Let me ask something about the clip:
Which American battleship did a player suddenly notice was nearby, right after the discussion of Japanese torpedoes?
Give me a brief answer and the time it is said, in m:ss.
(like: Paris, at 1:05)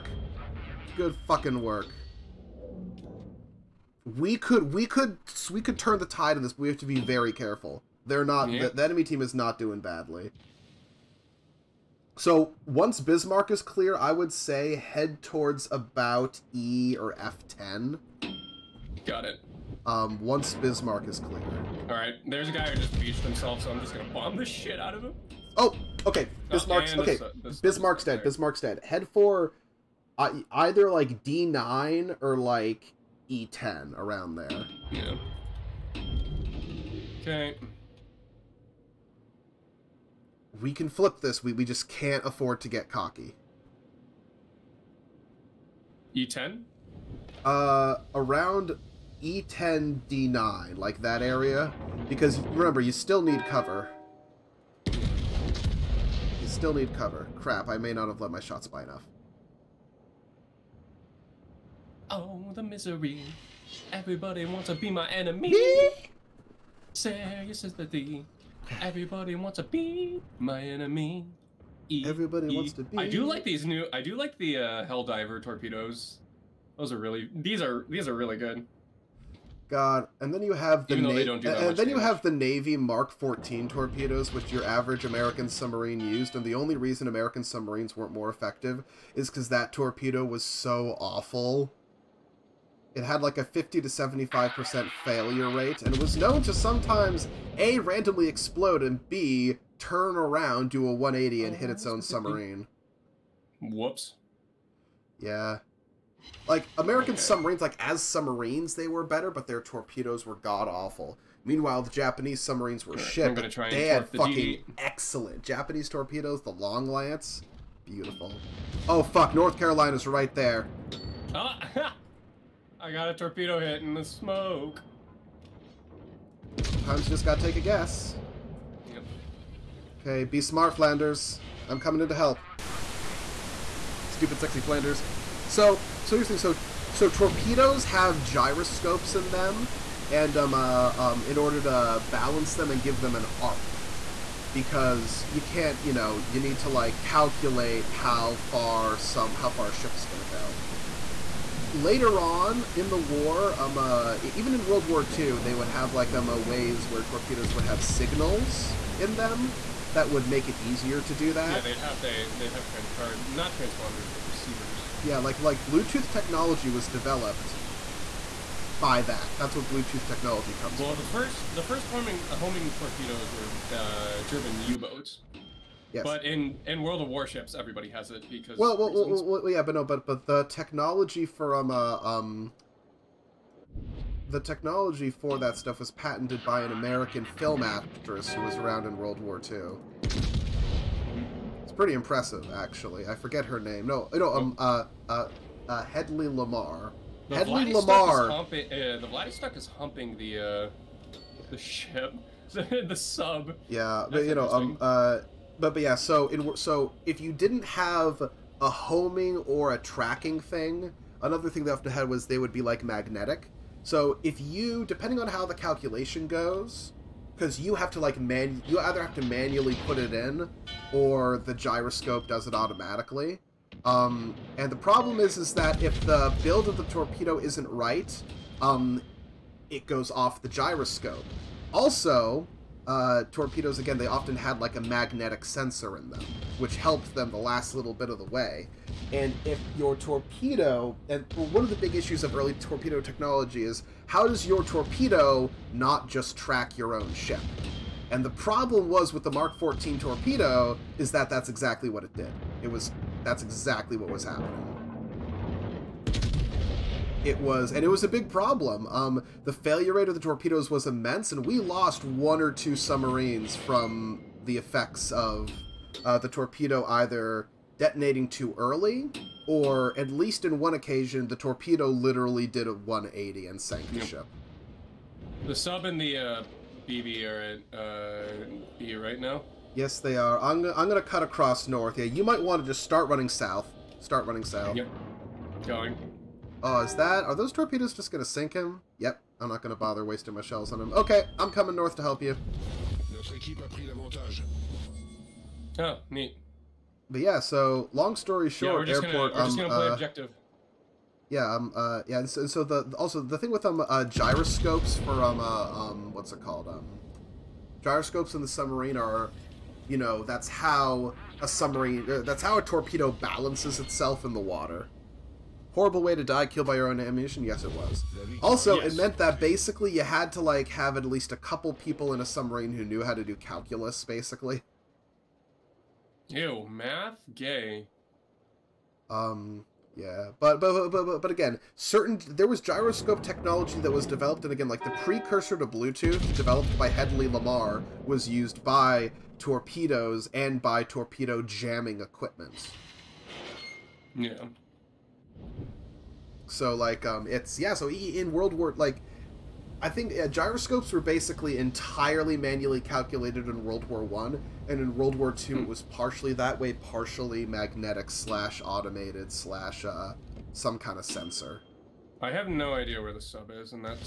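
North Carolina, at 1:59.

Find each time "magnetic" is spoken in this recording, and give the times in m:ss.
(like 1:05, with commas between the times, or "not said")
3:32, 3:54, 5:57.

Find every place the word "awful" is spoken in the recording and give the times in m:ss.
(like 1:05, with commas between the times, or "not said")
1:30, 1:50.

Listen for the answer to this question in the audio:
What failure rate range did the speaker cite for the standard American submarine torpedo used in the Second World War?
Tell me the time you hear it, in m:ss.
1:33.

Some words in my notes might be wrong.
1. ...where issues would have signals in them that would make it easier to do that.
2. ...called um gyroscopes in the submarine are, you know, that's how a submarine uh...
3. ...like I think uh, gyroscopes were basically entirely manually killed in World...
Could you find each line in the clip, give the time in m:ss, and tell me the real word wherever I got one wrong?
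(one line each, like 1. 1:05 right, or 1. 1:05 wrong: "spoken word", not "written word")
1. 2:36 wrong: "torpedoes", not "issues"
2. 5:06 right
3. 5:48 wrong: "calculated", not "killed".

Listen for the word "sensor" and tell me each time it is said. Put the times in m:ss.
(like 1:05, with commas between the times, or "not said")
3:55, 6:01.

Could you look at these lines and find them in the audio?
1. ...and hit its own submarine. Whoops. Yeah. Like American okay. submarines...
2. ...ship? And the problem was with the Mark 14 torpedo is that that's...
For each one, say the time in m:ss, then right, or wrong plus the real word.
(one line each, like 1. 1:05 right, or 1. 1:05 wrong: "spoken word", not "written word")
1. 1:41 right
2. 4:07 right.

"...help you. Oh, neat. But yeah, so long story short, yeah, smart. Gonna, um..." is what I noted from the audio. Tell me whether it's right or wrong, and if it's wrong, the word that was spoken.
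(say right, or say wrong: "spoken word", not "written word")
wrong: "airport", not "smart".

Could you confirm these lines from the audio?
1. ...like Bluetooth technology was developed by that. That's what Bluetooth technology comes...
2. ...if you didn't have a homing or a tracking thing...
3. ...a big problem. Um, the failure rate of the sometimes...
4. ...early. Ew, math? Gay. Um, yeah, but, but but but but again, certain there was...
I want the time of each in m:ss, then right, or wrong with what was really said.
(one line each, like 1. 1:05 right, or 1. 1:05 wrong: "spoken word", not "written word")
1. 2:45 right
2. 3:27 right
3. 4:18 wrong: "torpedoes", not "sometimes"
4. 5:24 wrong: "basically", not "early".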